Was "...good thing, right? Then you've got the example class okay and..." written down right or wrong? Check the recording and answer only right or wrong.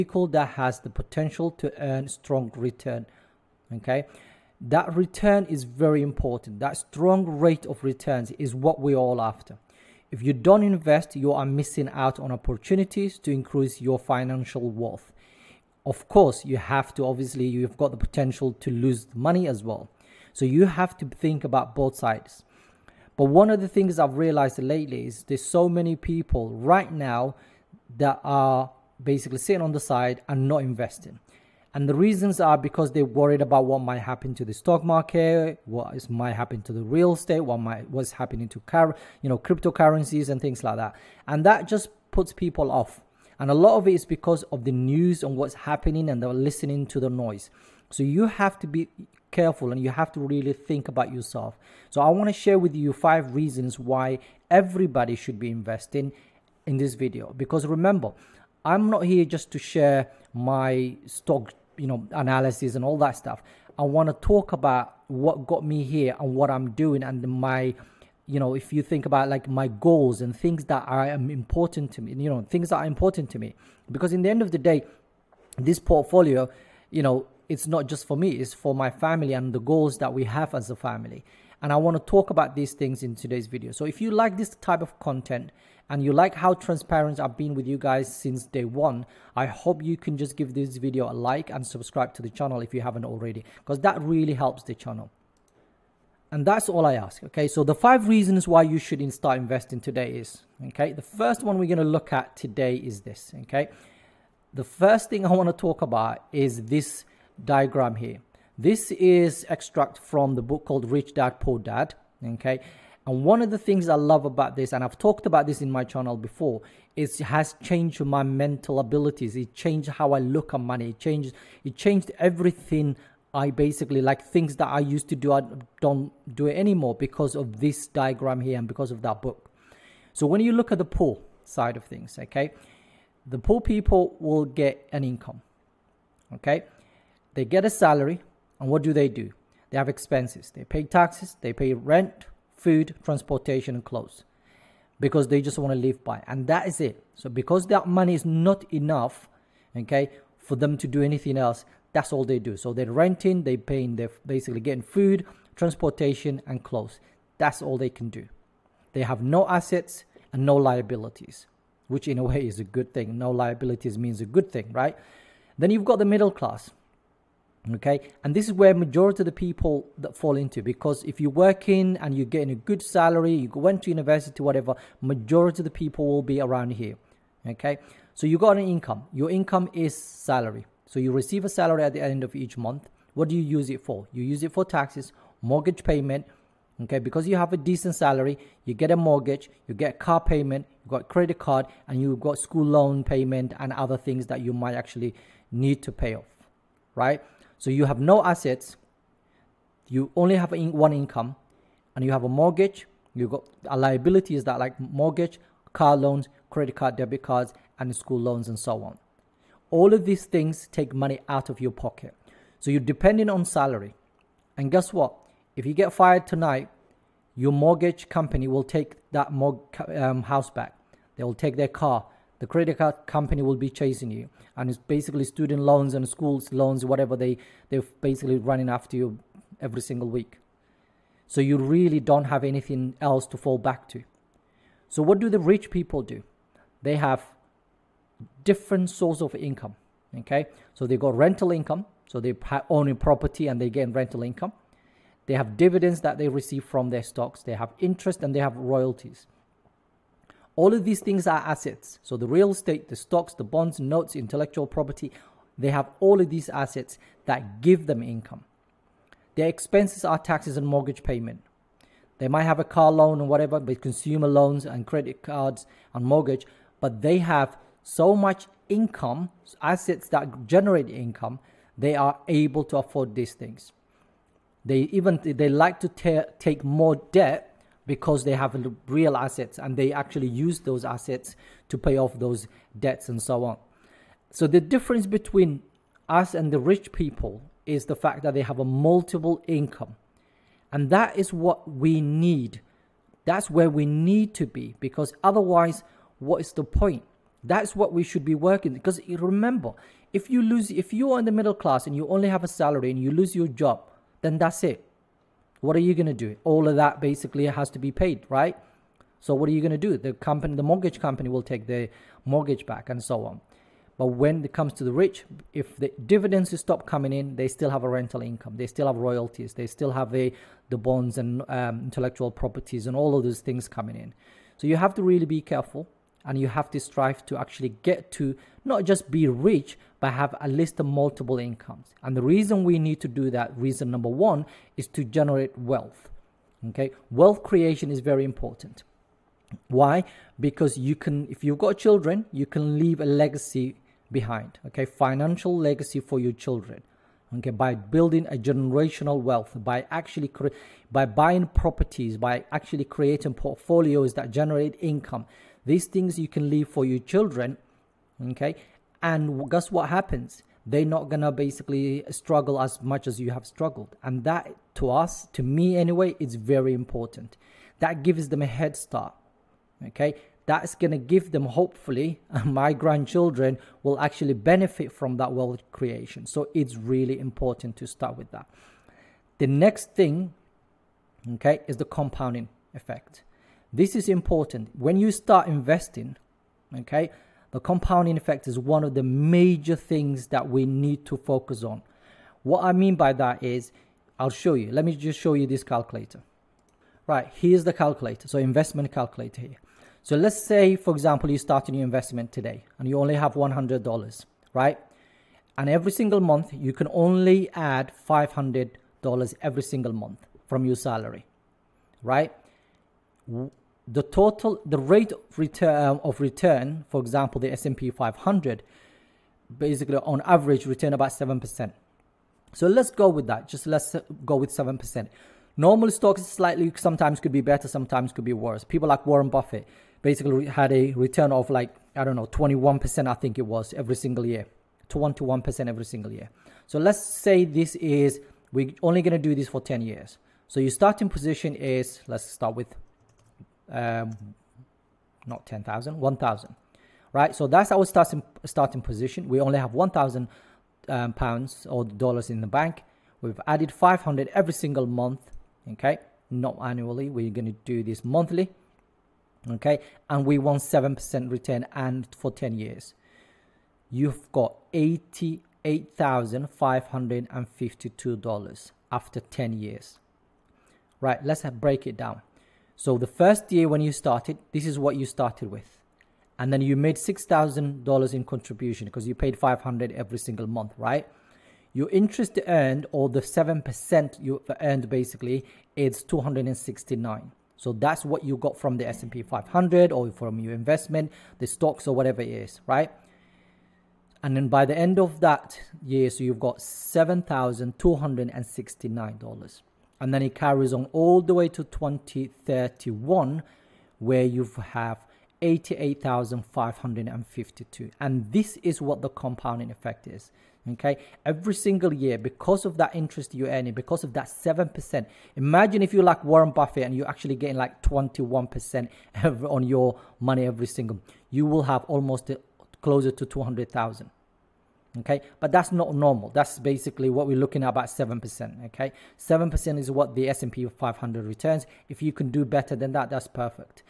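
wrong.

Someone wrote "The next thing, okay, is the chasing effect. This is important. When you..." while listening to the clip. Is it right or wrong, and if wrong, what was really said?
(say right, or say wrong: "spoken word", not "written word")
wrong: "compounding", not "chasing".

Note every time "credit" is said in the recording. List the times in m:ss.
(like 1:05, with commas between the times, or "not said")
3:11, 3:26, 3:42, 4:24.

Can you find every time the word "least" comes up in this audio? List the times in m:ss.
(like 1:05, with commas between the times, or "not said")
5:30.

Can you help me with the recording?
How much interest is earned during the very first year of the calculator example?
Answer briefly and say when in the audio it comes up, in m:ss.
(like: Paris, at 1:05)
269, at 8:06.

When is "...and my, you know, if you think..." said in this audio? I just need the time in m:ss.
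1:07.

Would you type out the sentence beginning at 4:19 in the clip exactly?
Their expenses are taxes and mortgage payment.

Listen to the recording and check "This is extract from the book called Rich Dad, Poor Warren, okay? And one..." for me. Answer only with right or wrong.
wrong.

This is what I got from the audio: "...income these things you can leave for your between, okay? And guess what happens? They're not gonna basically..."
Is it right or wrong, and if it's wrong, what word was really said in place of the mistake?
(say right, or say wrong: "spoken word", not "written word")
wrong: "children", not "between".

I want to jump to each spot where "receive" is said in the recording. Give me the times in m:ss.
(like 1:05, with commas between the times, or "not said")
3:01, 4:06.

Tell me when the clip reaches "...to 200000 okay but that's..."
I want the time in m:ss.
8:43.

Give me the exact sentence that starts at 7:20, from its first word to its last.
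So your starting position is let's start with um, not 10,000, 1,000, right?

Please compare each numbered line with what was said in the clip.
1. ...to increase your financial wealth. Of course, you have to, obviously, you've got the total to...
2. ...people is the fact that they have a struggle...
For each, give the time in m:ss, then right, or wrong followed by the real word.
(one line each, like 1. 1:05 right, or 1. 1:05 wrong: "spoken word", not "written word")
1. 0:13 wrong: "potential", not "total"
2. 4:46 wrong: "multiple", not "struggle".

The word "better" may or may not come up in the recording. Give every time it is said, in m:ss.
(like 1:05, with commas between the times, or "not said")
7:07, 8:52.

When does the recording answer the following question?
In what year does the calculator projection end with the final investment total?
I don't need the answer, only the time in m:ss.
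8:21.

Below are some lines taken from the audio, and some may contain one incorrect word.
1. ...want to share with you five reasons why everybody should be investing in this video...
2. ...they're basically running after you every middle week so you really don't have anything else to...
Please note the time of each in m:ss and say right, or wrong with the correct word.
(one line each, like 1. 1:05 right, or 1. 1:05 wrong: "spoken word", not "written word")
1. 0:52 right
2. 3:47 wrong: "single", not "middle".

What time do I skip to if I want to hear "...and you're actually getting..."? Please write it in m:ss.
8:36.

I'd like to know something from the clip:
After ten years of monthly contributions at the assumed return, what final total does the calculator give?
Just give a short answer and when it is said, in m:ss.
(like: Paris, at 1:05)
$88,552, at 7:44.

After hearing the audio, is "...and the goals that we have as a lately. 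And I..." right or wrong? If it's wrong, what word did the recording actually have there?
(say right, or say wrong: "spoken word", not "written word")
wrong: "family", not "lately".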